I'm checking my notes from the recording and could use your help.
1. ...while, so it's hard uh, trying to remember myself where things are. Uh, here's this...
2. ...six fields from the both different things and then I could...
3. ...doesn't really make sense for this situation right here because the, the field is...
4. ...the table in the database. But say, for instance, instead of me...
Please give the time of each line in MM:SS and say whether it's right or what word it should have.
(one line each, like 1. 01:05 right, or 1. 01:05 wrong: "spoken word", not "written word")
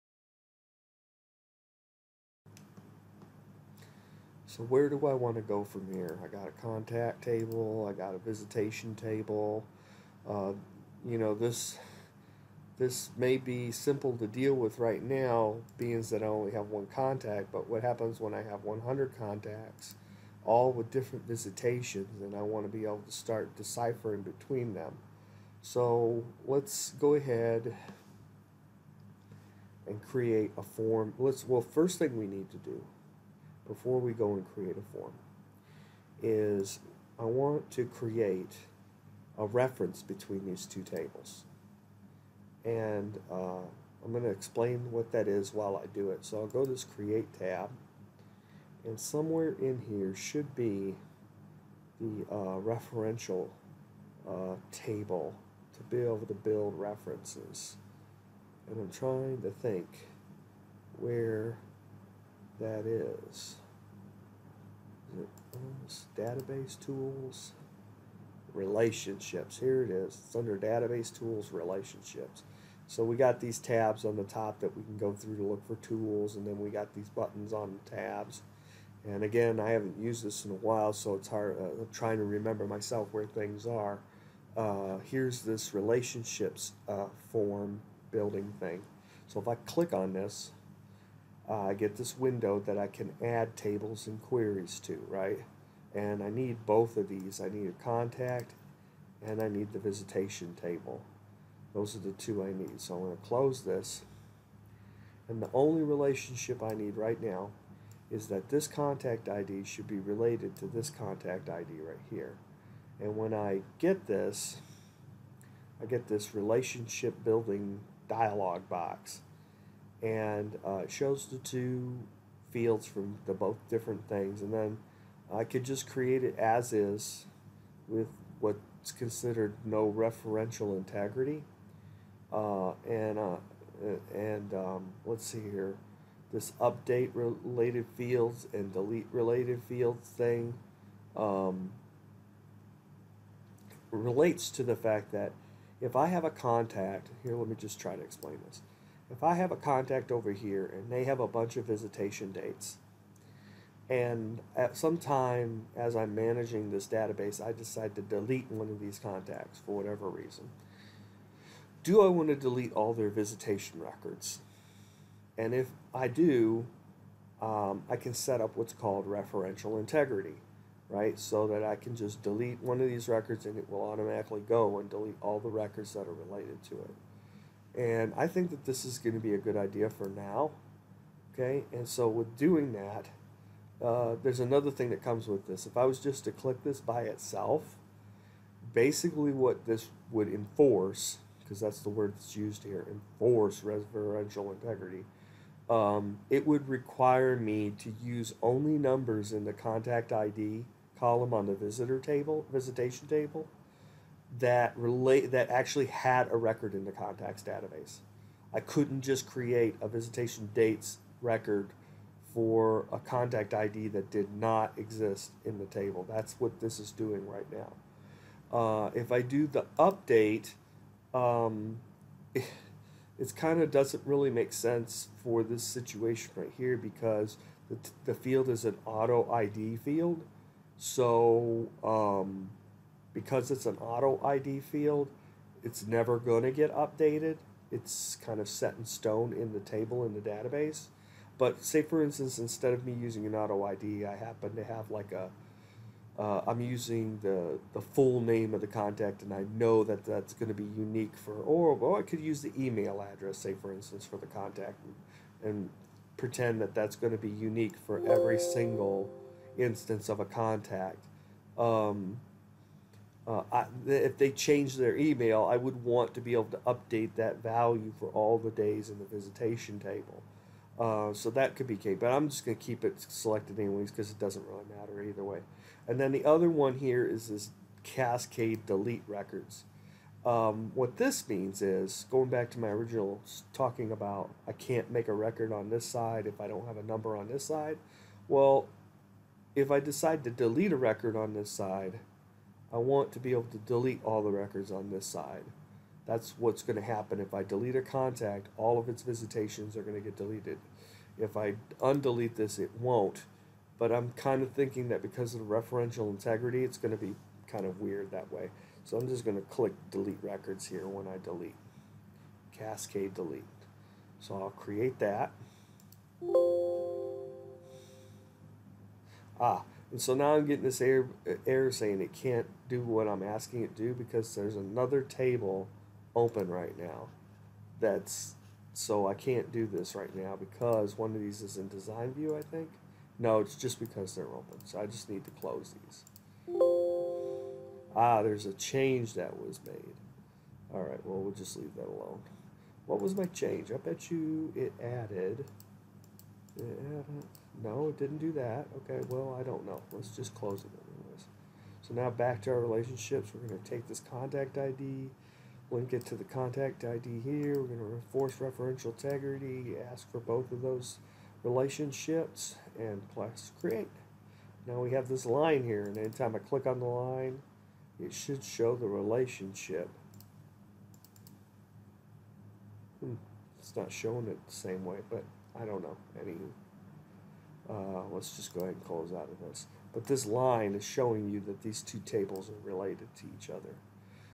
1. 01:20 right
2. 02:01 wrong: "two", not "six"
3. 03:43 right
4. 03:59 right.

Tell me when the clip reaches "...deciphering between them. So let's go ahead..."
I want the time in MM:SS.
00:23.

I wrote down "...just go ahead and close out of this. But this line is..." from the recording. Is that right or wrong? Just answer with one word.
right.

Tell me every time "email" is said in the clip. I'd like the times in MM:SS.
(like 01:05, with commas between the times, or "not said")
04:12, 04:24.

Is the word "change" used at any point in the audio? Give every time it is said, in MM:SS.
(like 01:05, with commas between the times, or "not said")
04:24, 05:38, 05:43.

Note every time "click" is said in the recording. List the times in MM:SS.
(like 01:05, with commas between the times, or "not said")
01:29, 03:06, 05:09, 06:06.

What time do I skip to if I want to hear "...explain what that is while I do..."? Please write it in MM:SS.
00:44.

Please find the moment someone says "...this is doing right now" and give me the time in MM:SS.
03:36.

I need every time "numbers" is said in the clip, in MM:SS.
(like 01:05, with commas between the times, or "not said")
03:18, 04:46.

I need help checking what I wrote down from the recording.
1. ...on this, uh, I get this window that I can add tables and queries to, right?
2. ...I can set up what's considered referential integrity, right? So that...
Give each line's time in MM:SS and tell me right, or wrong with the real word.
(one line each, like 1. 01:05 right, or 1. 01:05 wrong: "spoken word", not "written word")
1. 01:29 right
2. 02:47 wrong: "called", not "considered".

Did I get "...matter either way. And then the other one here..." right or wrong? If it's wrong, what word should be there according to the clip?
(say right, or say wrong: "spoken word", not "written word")
right.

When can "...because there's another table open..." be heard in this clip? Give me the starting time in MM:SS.
05:23.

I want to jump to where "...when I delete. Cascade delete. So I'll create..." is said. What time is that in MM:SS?
05:10.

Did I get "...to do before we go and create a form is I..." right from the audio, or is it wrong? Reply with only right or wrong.
right.